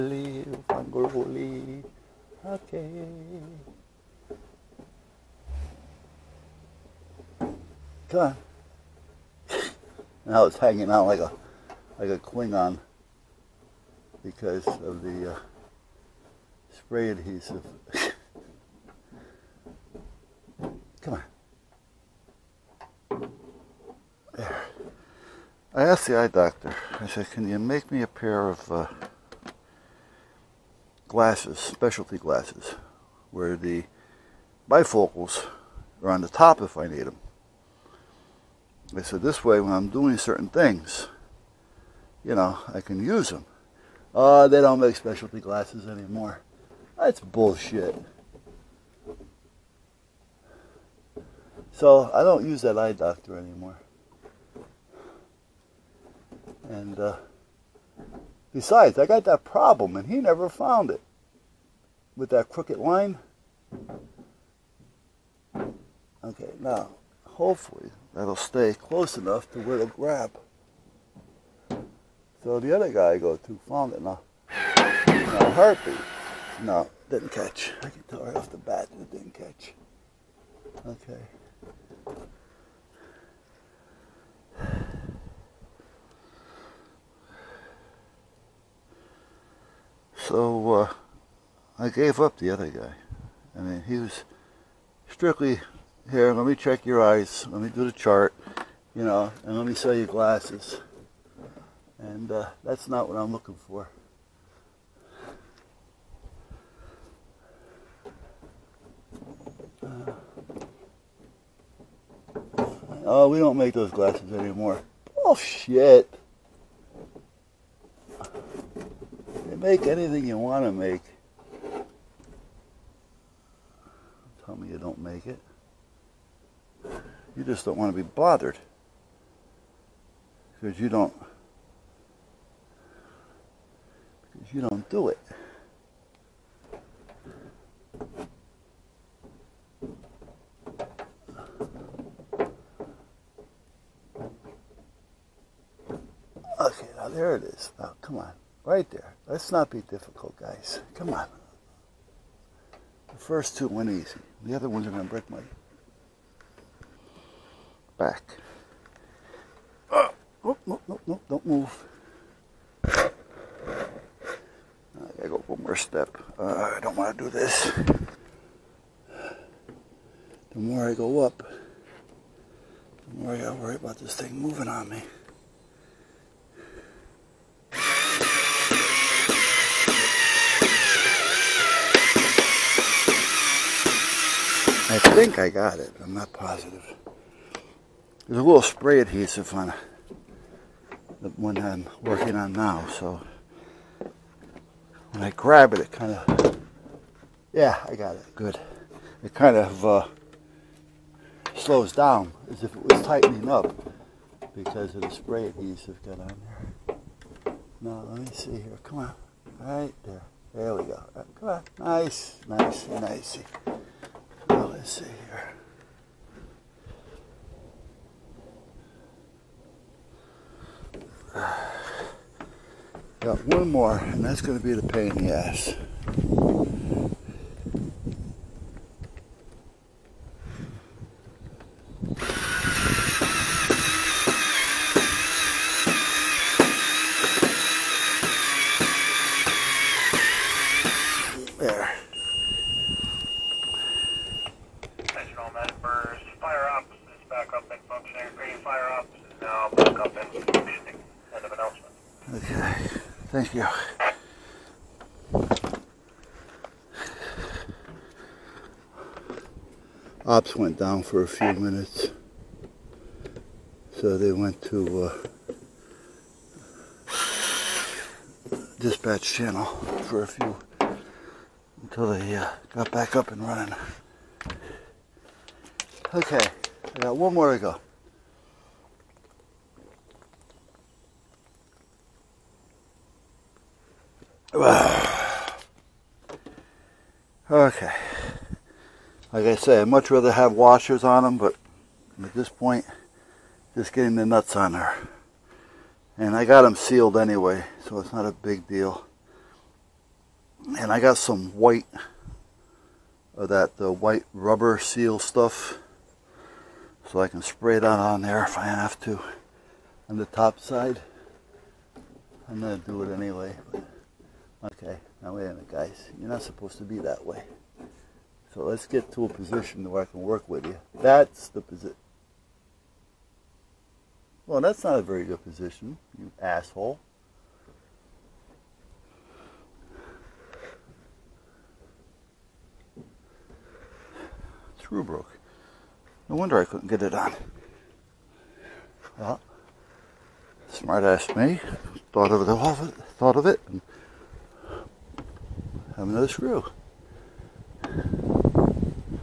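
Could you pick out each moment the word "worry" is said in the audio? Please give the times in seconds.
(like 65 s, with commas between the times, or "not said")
173 s.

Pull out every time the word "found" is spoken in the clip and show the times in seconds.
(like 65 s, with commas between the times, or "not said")
60 s, 73 s.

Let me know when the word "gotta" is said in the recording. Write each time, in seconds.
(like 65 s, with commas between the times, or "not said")
173 s.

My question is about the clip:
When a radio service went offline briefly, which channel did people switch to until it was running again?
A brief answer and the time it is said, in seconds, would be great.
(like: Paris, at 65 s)
Dispatch channel, at 268 s.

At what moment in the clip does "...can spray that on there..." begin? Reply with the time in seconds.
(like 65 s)
307 s.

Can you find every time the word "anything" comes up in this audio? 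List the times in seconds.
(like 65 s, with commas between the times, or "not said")
119 s.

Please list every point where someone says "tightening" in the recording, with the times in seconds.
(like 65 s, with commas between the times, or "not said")
203 s.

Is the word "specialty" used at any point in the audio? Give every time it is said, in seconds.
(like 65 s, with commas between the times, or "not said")
31 s, 44 s.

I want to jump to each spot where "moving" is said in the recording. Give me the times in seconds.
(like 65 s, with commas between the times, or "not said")
174 s.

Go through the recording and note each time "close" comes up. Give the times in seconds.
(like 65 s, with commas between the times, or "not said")
68 s.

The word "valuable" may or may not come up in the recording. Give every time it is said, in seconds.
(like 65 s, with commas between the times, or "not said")
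not said.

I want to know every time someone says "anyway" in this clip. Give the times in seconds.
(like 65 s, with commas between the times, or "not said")
297 s, 313 s.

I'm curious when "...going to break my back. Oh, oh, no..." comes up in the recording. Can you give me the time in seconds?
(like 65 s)
154 s.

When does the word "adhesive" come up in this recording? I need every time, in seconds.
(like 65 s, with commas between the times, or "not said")
17 s, 188 s, 205 s.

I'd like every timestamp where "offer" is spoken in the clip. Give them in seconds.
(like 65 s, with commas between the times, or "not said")
not said.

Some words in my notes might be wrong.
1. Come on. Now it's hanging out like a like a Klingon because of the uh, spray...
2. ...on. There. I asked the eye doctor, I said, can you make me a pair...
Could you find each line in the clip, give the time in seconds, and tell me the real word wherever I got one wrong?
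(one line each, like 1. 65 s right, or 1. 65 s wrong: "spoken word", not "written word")
1. 8 s right
2. 21 s right.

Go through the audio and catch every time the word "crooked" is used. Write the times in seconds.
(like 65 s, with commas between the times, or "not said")
62 s.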